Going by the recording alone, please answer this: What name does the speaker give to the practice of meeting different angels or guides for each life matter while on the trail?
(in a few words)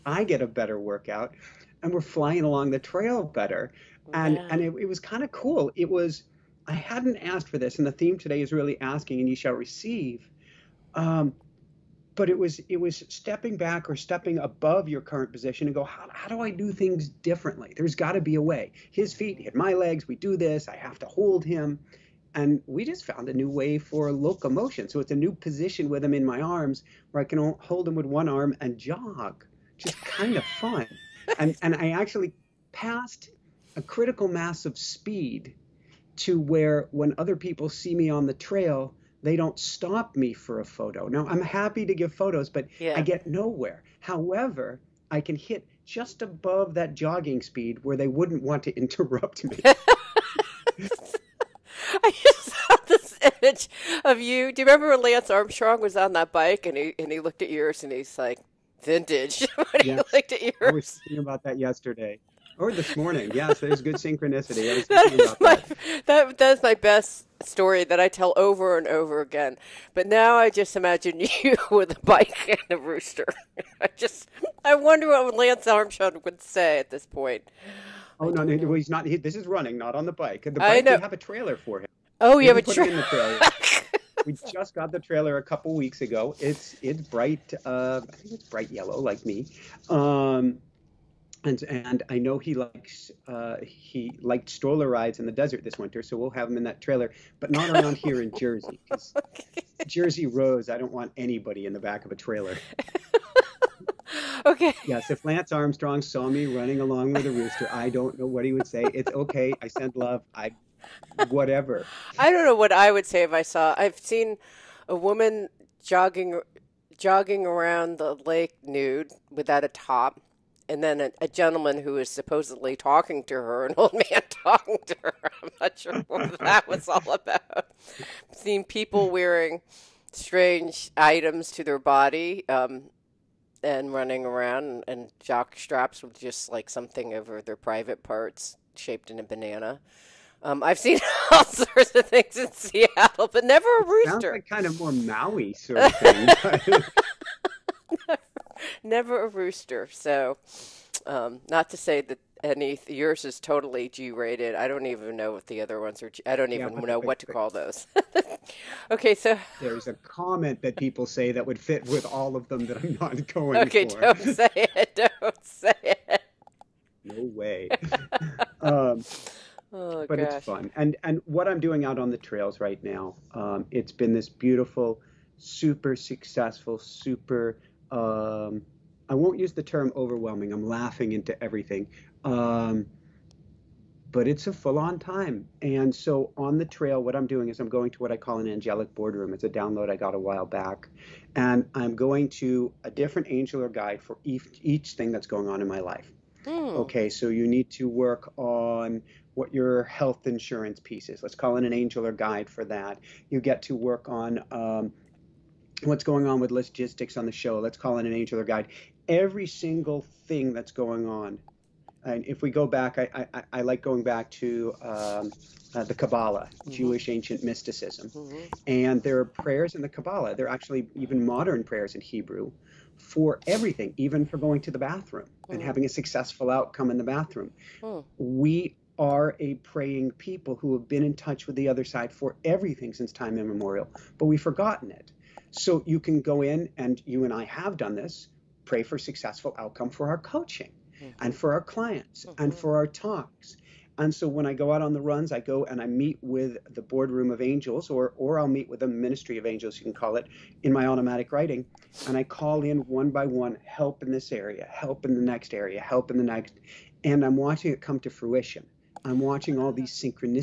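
Angelic boardroom.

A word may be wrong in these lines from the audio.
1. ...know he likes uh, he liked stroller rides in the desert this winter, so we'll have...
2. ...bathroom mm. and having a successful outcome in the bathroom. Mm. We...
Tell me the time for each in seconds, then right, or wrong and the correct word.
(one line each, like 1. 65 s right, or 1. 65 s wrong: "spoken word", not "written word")
1. 92 s right
2. 224 s right.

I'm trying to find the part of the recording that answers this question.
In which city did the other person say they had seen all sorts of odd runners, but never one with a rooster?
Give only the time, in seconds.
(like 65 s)
142 s.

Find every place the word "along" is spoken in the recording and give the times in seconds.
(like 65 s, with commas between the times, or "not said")
2 s, 106 s.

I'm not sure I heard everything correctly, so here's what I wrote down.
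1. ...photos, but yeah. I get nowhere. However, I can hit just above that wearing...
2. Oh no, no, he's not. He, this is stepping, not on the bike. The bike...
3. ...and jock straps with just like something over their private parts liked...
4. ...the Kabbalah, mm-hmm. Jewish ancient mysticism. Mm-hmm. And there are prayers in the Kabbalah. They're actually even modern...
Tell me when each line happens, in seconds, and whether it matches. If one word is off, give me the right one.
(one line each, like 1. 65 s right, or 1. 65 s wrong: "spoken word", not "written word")
1. 42 s wrong: "jogging", not "wearing"
2. 78 s wrong: "running", not "stepping"
3. 134 s wrong: "shaped", not "liked"
4. 215 s right.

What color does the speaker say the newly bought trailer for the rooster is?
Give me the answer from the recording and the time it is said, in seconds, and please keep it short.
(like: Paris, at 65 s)
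Bright yellow, at 88 s.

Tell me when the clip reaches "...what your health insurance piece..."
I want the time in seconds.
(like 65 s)
199 s.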